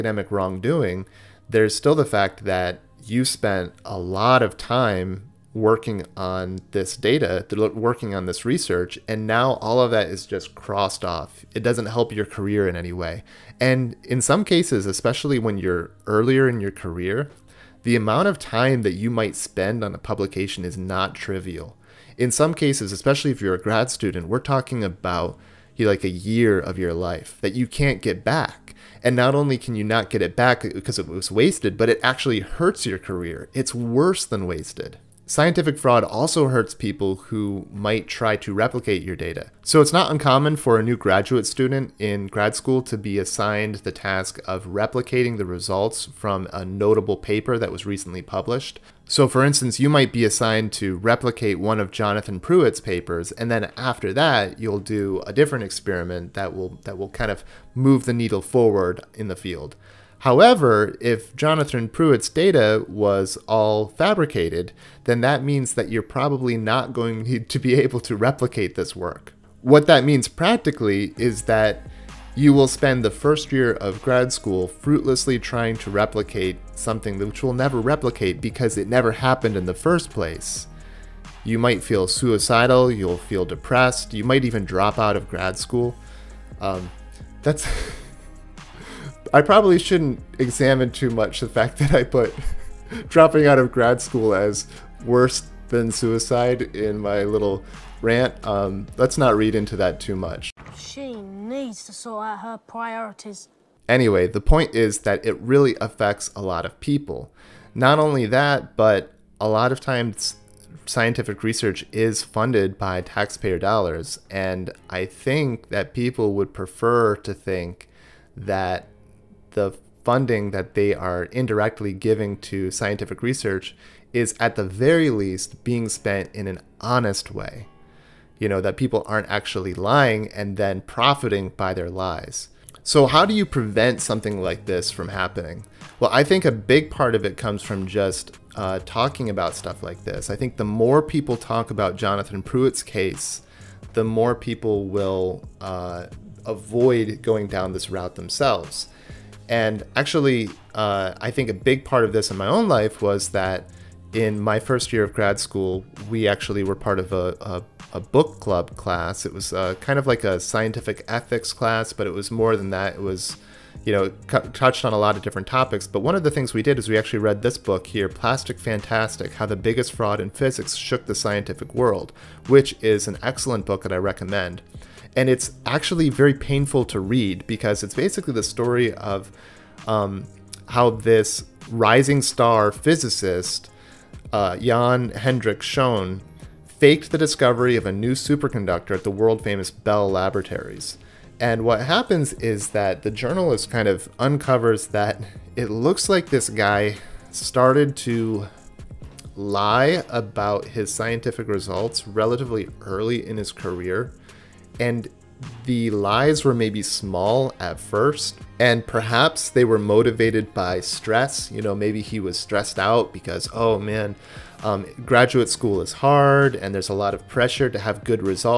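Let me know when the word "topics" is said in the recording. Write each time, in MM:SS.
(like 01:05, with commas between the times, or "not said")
02:45.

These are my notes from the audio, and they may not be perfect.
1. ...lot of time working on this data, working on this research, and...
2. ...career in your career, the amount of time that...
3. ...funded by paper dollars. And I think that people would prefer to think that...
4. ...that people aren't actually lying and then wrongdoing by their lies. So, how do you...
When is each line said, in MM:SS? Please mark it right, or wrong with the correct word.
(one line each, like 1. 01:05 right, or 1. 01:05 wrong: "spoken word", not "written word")
1. 00:03 right
2. 00:16 wrong: "earlier", not "career"
3. 01:52 wrong: "taxpayer", not "paper"
4. 02:08 wrong: "profiting", not "wrongdoing".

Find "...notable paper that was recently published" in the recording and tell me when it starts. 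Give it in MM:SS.
00:46.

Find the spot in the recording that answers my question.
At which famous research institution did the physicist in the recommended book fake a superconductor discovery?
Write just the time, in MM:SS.
03:09.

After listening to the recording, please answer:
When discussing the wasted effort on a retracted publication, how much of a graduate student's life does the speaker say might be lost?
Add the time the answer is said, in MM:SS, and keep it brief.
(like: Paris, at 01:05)
a year, at 00:26.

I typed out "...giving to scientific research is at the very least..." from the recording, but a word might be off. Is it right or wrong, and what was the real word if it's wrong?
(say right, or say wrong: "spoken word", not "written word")
right.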